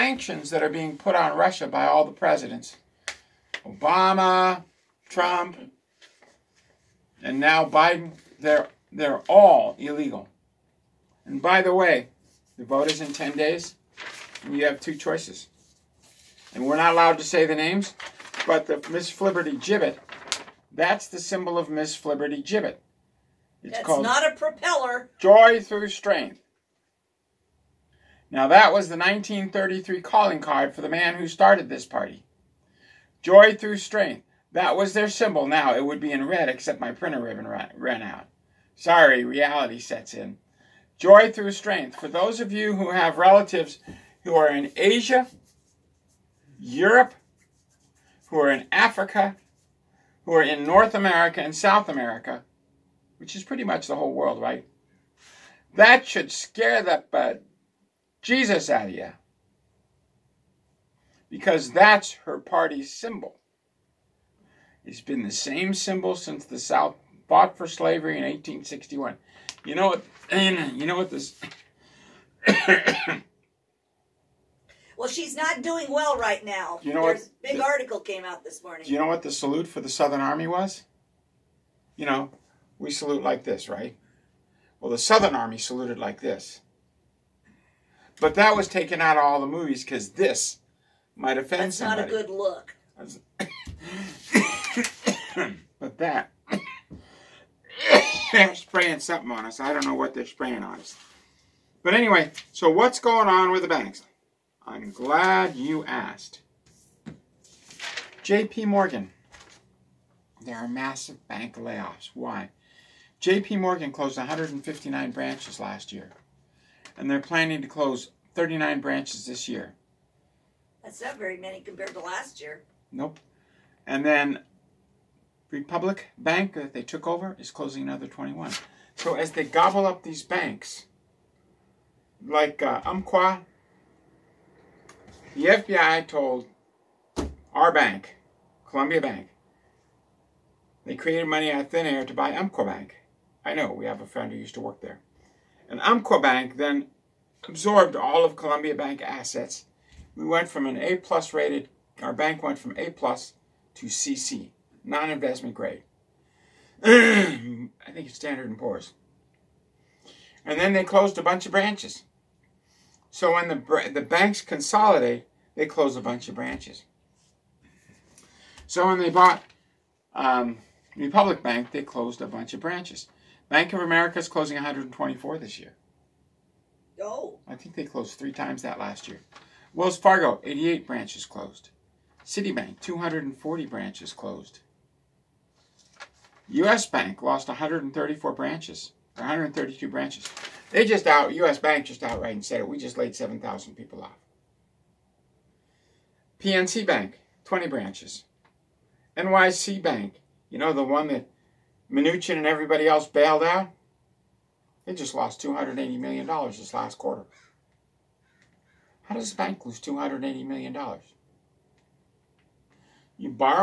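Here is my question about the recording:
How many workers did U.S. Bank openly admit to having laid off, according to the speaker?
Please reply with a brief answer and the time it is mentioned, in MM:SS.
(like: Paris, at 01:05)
7,000, at 03:13.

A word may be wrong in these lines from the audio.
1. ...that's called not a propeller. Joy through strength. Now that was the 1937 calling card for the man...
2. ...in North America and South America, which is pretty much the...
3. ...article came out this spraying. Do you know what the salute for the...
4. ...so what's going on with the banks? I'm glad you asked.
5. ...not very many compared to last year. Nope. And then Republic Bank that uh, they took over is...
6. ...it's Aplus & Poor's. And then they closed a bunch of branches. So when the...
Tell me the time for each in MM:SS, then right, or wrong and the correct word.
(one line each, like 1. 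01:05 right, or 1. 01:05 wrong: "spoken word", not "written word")
1. 00:23 wrong: "1933", not "1937"
2. 00:50 right
3. 01:17 wrong: "morning", not "spraying"
4. 01:42 right
5. 02:01 right
6. 02:38 wrong: "Standard", not "Aplus".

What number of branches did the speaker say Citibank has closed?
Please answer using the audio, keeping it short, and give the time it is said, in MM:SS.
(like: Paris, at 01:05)
240, at 03:02.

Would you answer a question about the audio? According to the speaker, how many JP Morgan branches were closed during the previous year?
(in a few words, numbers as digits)
159.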